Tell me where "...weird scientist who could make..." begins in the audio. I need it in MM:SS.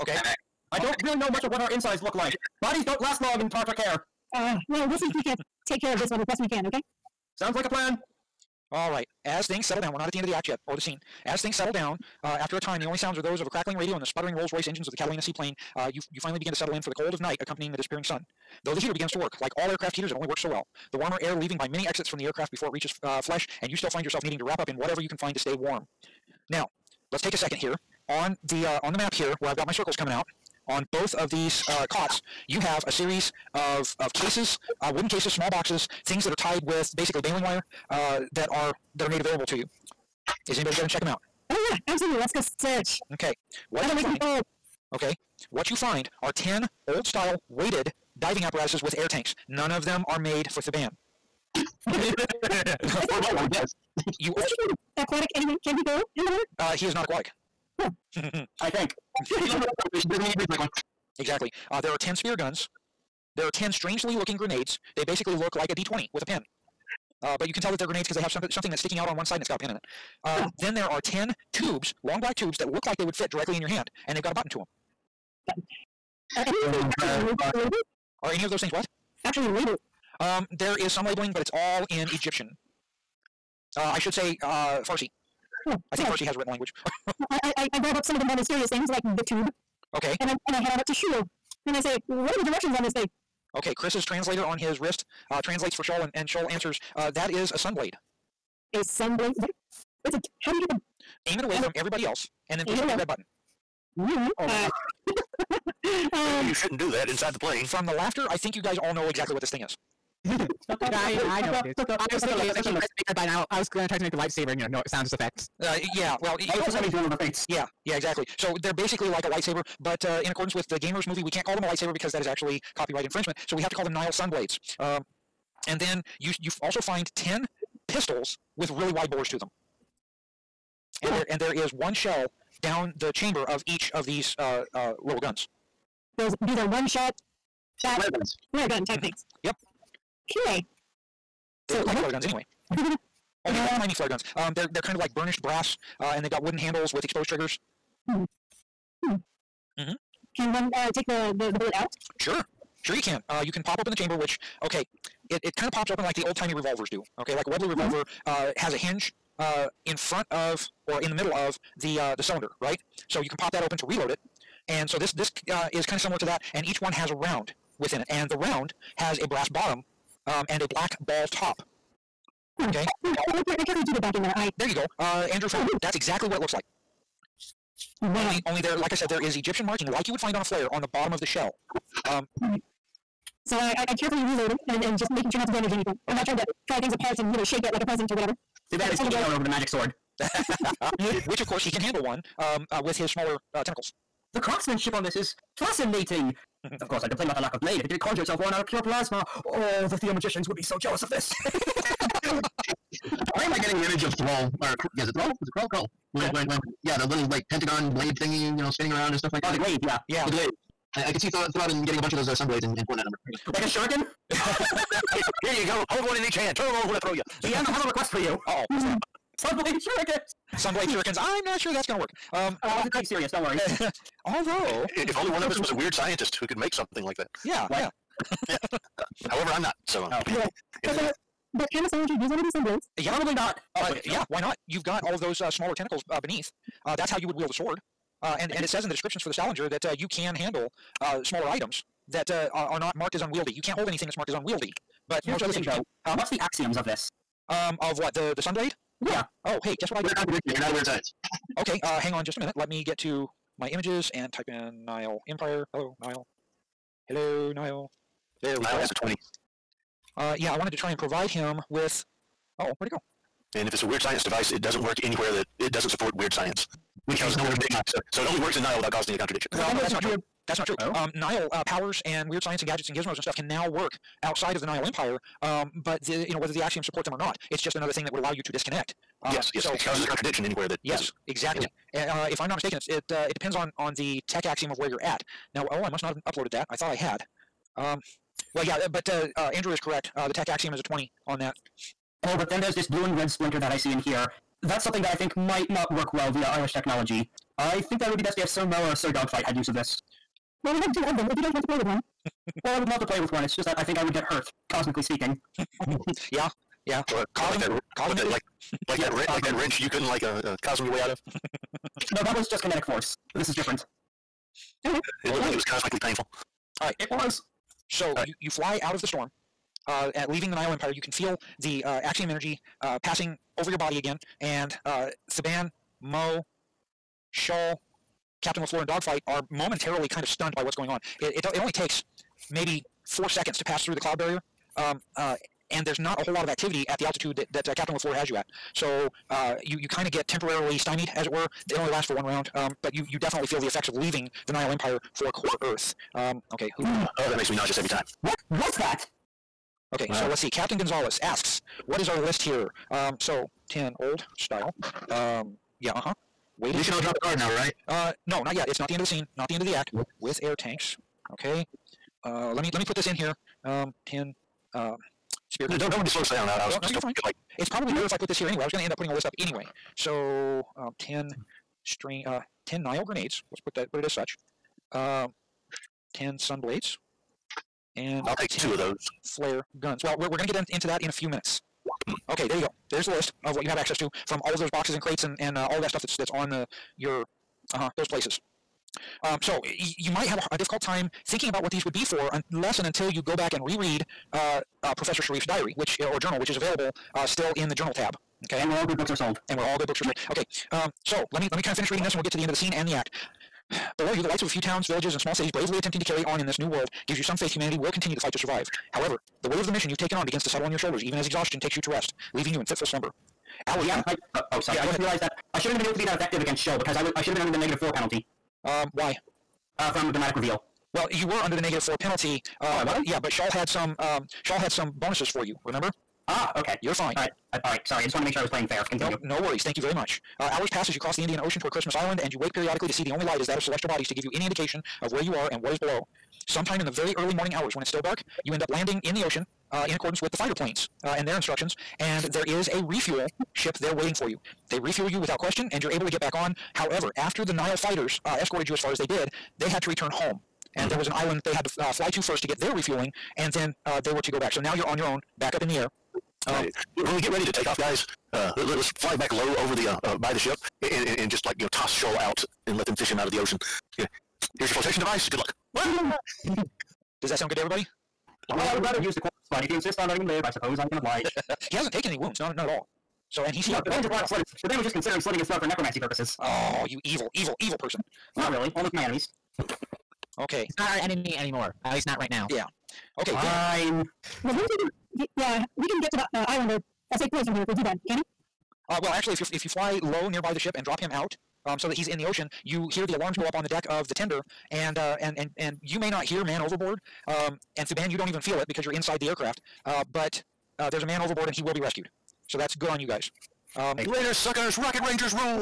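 03:45.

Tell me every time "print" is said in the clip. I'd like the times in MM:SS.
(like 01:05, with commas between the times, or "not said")
not said.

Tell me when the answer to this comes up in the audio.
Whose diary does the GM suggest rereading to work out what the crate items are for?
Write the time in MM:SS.
06:34.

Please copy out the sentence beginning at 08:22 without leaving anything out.
So that's good on you guys.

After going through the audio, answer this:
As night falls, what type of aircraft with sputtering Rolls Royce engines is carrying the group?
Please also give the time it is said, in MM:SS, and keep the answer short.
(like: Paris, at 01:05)
Catalina seaplane, at 00:14.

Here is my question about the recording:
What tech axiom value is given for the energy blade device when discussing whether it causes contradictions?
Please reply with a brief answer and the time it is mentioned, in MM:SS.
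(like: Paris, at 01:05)
20, at 04:50.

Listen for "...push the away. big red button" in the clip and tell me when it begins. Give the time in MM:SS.
01:42.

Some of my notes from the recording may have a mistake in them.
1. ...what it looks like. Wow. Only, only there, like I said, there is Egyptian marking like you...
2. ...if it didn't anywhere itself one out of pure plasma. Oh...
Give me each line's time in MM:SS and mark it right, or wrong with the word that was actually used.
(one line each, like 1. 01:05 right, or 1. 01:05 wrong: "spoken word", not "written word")
1. 02:56 right
2. 03:17 wrong: "conjure", not "anywhere".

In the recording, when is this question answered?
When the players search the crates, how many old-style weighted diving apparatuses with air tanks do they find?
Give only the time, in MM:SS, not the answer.
00:46.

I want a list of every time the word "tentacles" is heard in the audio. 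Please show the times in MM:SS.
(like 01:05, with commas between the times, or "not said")
03:13, 03:55.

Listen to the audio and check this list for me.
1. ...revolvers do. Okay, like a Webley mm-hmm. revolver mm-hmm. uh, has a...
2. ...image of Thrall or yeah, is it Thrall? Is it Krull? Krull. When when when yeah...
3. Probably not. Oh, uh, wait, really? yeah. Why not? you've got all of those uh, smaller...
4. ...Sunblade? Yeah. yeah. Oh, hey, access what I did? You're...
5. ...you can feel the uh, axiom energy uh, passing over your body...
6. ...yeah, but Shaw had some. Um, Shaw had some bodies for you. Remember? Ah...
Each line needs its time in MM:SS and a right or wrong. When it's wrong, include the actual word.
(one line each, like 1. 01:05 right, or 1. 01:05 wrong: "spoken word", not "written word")
1. 02:36 right
2. 03:23 right
3. 03:53 right
4. 04:08 wrong: "guess", not "access"
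5. 05:20 right
6. 07:03 wrong: "bonuses", not "bodies".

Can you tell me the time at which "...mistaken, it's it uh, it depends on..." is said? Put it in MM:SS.
04:42.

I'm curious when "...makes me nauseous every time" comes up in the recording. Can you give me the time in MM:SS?
05:47.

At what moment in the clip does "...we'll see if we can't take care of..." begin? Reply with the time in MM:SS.
00:04.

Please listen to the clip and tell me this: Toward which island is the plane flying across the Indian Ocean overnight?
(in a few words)
Christmas Island.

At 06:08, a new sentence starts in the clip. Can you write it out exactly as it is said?
I was going to end up putting a list up anyway.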